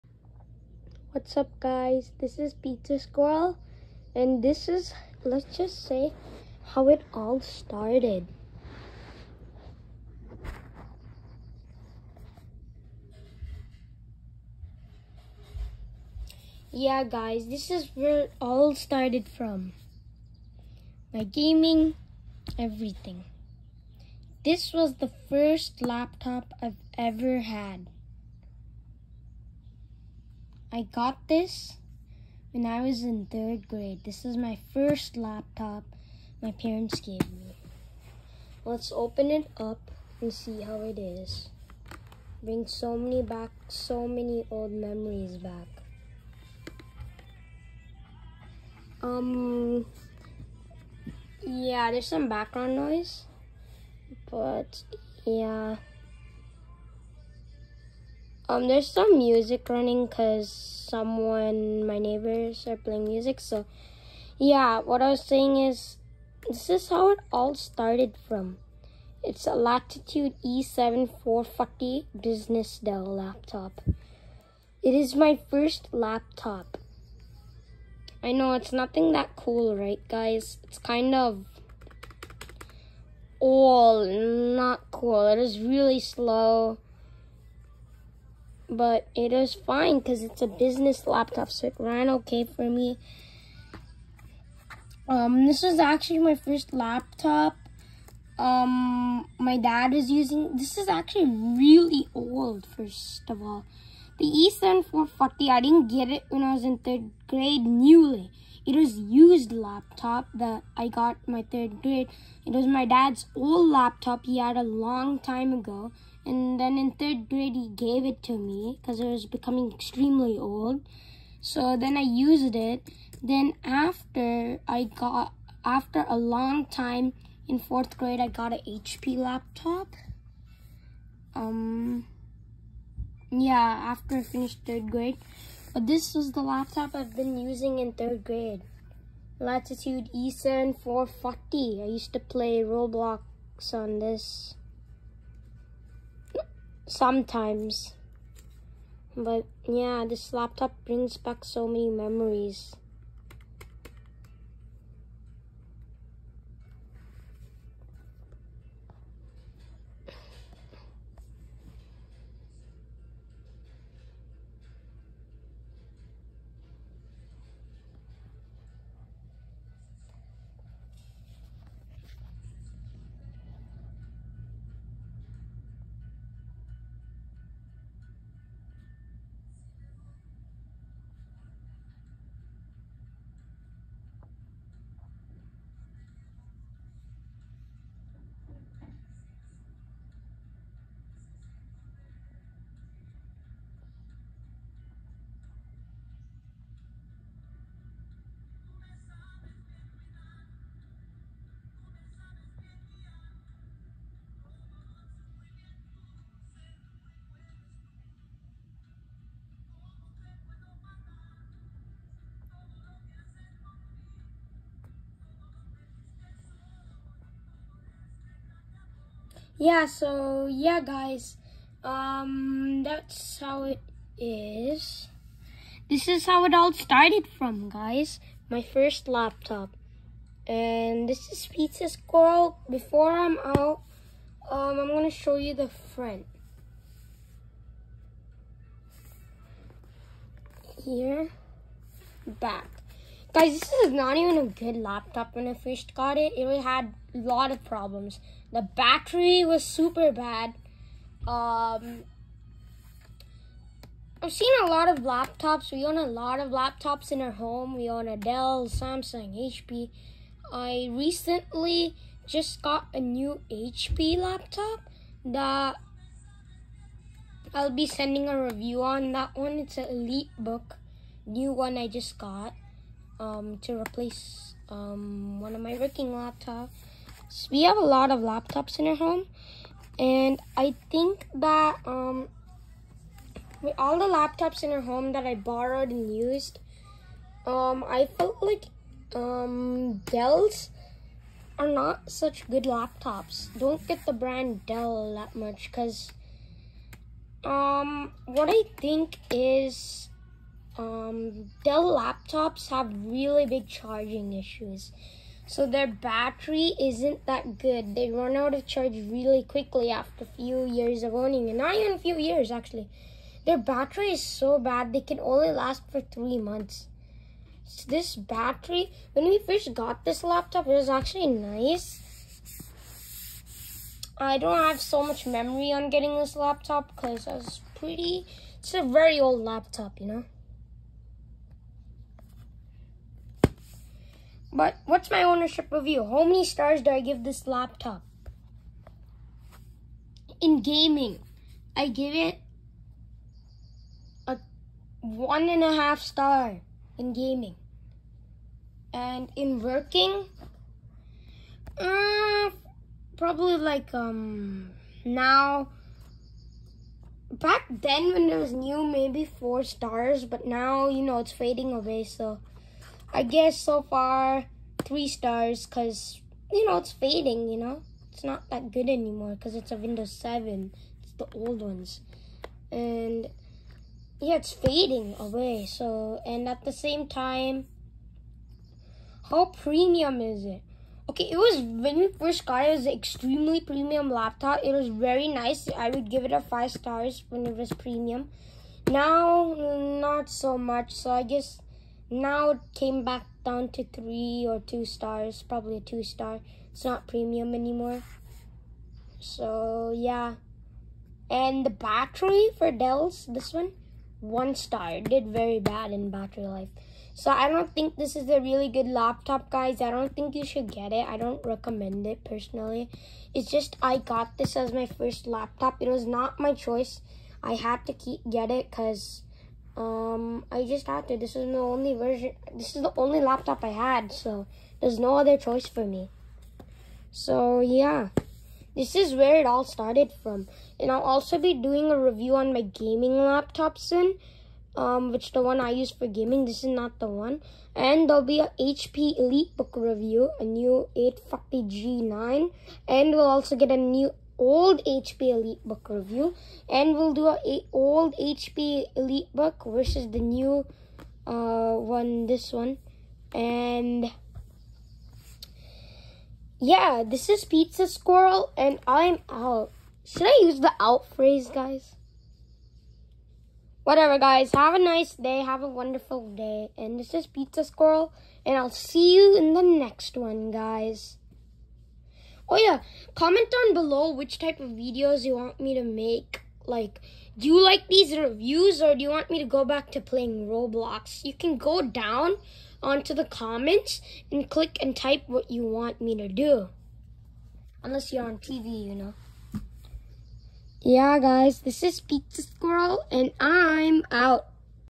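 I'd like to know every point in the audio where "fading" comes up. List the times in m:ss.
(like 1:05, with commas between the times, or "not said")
6:01, 6:06, 6:14.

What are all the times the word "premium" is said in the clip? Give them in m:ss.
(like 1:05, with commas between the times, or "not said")
6:19, 6:23, 6:27, 6:37.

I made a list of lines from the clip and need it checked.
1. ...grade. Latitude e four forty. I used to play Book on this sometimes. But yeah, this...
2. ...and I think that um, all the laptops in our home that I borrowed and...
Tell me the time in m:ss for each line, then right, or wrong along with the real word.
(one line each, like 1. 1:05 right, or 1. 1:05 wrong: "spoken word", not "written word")
1. 2:18 wrong: "Roblox", not "Book"
2. 4:39 right.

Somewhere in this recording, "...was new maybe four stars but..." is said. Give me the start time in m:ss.
5:58.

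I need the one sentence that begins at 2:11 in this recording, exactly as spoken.
Um, yeah, after I finished third grade.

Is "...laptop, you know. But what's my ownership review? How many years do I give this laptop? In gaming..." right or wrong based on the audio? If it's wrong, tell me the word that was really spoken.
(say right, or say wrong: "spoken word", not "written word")
wrong: "stars", not "years".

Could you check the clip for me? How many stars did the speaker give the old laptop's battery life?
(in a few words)
1 star.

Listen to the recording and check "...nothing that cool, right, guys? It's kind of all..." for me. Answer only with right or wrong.
right.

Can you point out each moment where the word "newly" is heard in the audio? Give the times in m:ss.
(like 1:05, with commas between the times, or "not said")
1:47.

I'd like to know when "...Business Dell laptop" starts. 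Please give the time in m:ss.
1:12.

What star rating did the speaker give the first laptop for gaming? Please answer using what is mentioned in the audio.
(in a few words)
1.5 stars.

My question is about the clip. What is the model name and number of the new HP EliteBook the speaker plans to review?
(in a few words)
850G9.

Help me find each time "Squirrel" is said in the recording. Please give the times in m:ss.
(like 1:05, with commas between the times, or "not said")
0:02, 3:51, 7:37, 7:47, 8:12.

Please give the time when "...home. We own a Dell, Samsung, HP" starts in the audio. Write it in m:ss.
4:17.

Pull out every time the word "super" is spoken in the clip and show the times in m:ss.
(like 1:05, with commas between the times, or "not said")
4:09.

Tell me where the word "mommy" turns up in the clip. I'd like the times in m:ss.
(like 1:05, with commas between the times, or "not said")
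not said.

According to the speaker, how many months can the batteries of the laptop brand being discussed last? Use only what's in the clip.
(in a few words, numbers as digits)
3 months.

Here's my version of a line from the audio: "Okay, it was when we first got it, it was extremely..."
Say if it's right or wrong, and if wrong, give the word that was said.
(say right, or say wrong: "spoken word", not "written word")
right.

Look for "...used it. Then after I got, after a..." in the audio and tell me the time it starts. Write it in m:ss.
2:02.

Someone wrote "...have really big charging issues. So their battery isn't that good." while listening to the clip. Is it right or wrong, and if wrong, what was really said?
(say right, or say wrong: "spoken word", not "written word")
right.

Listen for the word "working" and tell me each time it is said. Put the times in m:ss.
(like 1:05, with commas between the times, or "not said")
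4:35, 5:49.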